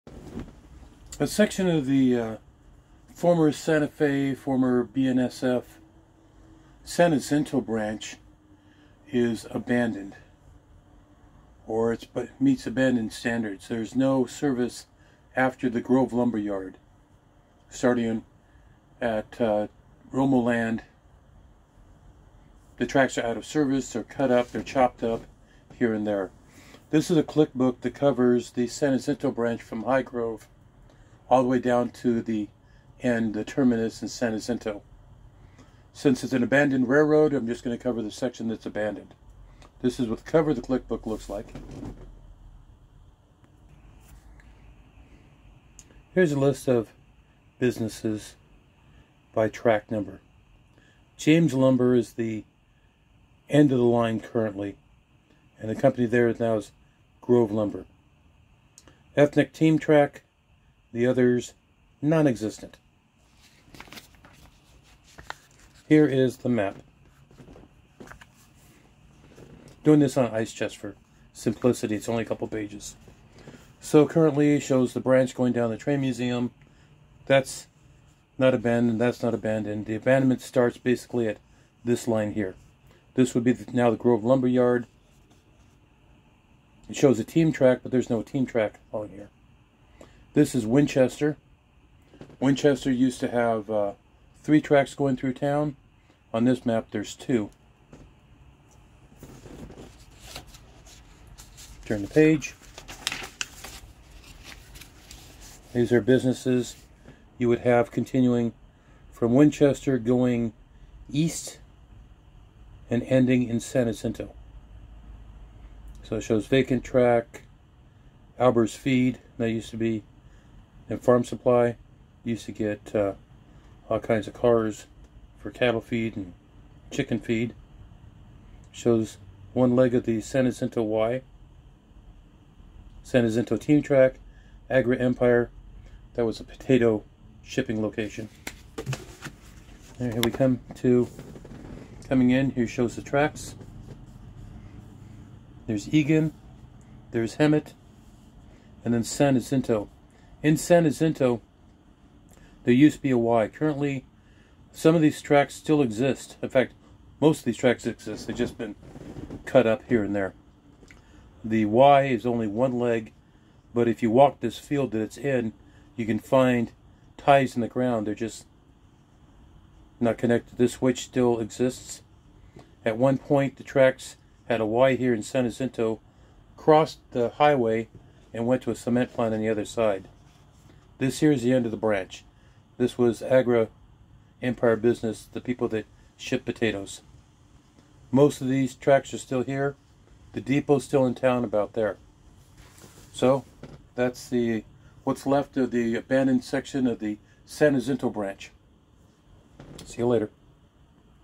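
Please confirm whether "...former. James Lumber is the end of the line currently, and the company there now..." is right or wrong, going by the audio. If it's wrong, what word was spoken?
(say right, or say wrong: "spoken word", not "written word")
wrong: "number", not "former".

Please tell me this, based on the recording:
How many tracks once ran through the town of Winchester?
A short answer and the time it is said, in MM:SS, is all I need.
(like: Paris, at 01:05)
3, at 01:34.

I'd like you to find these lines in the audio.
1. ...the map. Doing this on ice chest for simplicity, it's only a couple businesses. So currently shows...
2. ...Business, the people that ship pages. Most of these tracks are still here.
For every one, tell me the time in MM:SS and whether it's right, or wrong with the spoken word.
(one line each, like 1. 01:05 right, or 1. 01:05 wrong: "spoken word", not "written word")
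1. 01:06 wrong: "pages", not "businesses"
2. 03:04 wrong: "potatoes", not "pages".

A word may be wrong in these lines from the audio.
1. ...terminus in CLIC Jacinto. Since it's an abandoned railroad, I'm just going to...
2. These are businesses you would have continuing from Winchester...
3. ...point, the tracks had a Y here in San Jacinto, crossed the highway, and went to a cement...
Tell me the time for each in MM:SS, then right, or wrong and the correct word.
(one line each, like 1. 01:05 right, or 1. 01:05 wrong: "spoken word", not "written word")
1. 00:33 wrong: "San", not "CLIC"
2. 01:45 right
3. 02:53 right.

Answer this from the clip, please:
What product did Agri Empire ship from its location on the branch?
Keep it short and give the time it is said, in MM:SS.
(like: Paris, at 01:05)
Potatoes, at 02:16.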